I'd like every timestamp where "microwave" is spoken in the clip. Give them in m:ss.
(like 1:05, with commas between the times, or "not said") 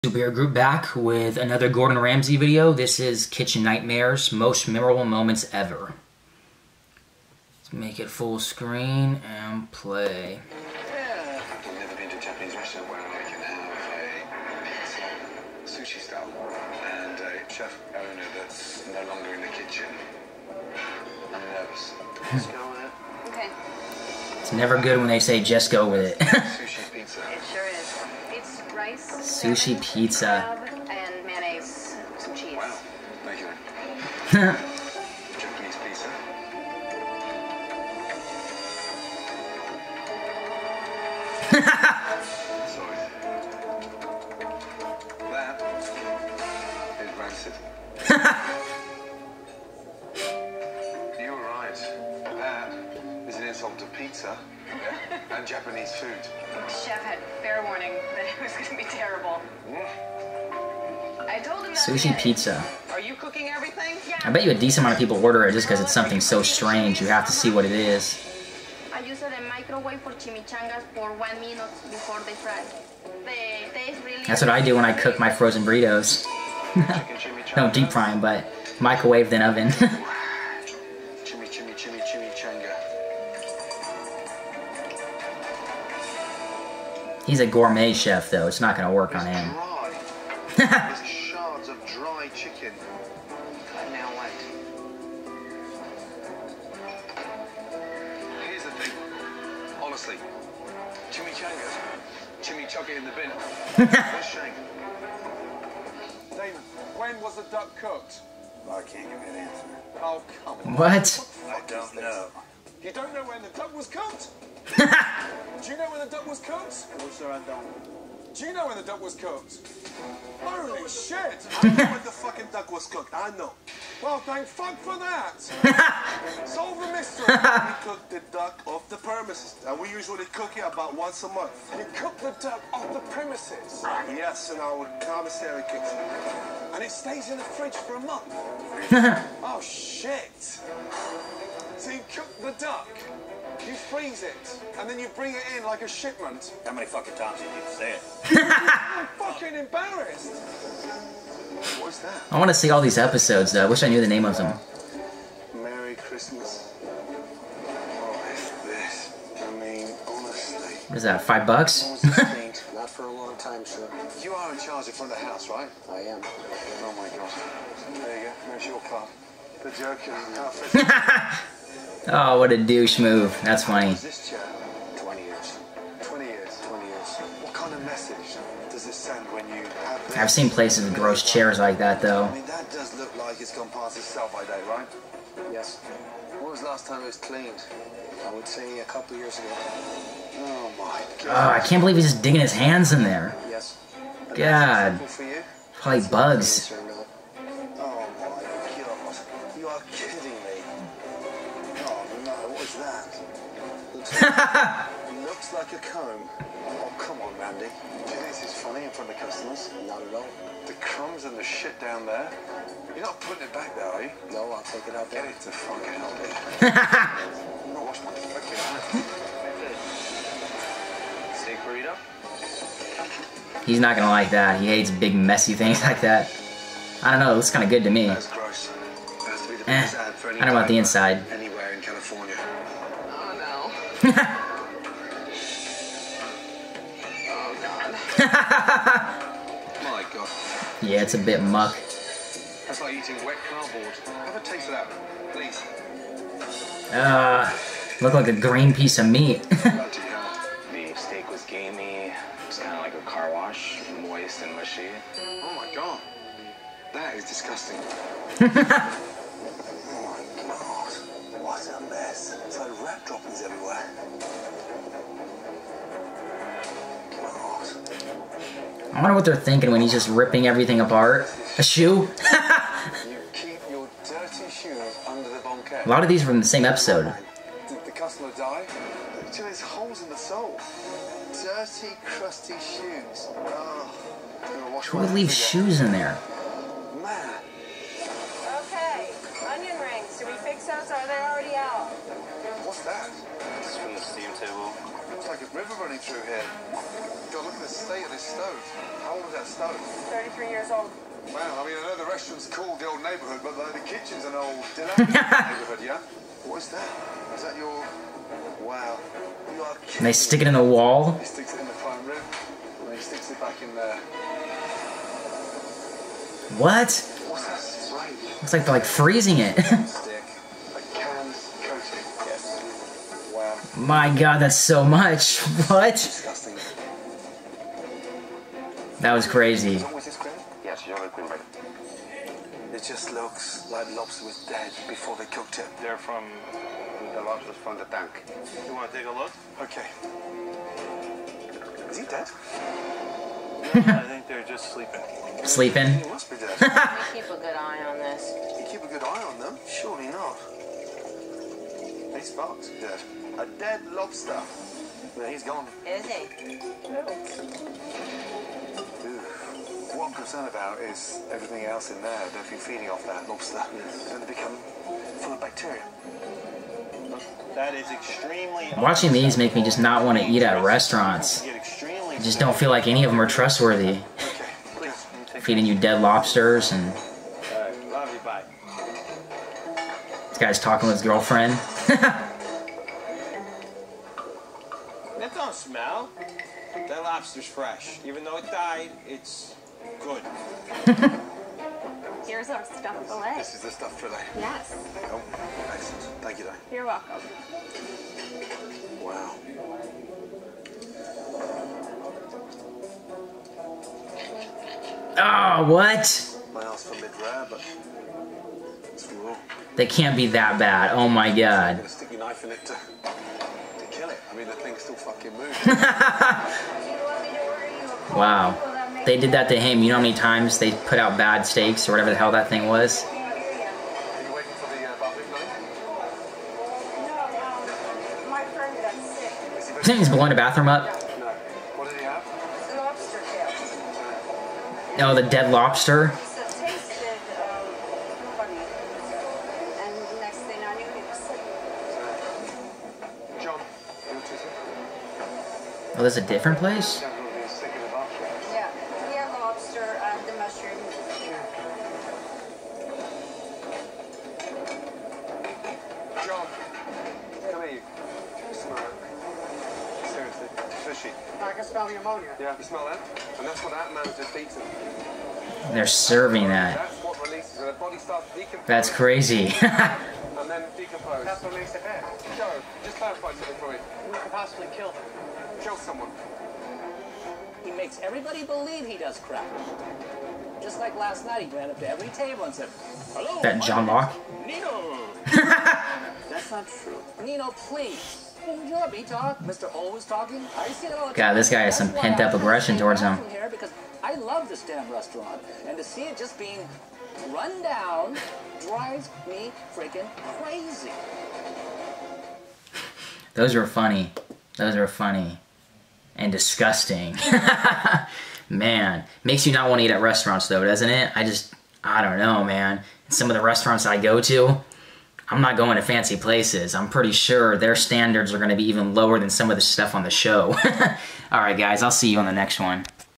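1:09, 1:18.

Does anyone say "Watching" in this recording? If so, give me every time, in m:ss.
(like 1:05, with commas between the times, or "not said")
6:08.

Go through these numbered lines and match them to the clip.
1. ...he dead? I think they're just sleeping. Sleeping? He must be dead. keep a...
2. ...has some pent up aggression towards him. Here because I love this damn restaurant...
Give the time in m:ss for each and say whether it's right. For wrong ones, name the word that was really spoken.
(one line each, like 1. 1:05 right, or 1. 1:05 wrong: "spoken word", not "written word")
1. 5:41 right
2. 8:11 right.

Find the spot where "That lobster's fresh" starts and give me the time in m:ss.
6:26.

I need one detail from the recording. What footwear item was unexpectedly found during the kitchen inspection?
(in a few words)
A shoe.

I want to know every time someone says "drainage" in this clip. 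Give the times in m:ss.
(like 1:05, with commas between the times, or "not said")
not said.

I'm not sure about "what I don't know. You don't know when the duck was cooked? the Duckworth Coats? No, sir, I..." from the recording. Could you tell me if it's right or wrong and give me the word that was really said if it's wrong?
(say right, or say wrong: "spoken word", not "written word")
right.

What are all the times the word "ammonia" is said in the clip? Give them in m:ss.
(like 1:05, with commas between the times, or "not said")
7:41.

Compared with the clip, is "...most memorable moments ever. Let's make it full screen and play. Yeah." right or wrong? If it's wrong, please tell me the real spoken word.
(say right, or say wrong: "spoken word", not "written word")
right.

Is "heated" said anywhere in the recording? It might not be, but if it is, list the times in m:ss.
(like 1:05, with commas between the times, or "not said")
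not said.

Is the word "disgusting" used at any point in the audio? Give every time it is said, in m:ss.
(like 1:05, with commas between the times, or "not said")
4:17, 8:26.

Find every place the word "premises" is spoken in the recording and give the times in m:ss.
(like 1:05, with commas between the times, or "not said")
2:08, 2:13.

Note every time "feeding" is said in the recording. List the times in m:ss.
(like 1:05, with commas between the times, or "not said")
6:02, 6:15.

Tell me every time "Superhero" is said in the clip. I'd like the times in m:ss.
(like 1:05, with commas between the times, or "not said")
0:00.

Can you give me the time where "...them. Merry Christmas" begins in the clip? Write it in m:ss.
2:34.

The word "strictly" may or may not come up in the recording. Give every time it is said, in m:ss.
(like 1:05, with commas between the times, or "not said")
not said.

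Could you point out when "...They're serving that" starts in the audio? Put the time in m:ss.
7:45.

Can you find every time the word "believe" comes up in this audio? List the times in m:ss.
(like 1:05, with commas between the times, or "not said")
3:11, 7:58.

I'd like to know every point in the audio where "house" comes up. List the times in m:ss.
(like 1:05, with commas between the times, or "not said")
2:45.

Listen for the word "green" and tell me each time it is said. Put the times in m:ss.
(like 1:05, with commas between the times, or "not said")
4:08.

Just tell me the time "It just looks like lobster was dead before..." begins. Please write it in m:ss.
5:29.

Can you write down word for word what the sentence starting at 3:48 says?
Eh, I don't want the inside.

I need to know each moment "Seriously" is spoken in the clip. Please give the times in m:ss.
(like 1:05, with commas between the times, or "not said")
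7:40.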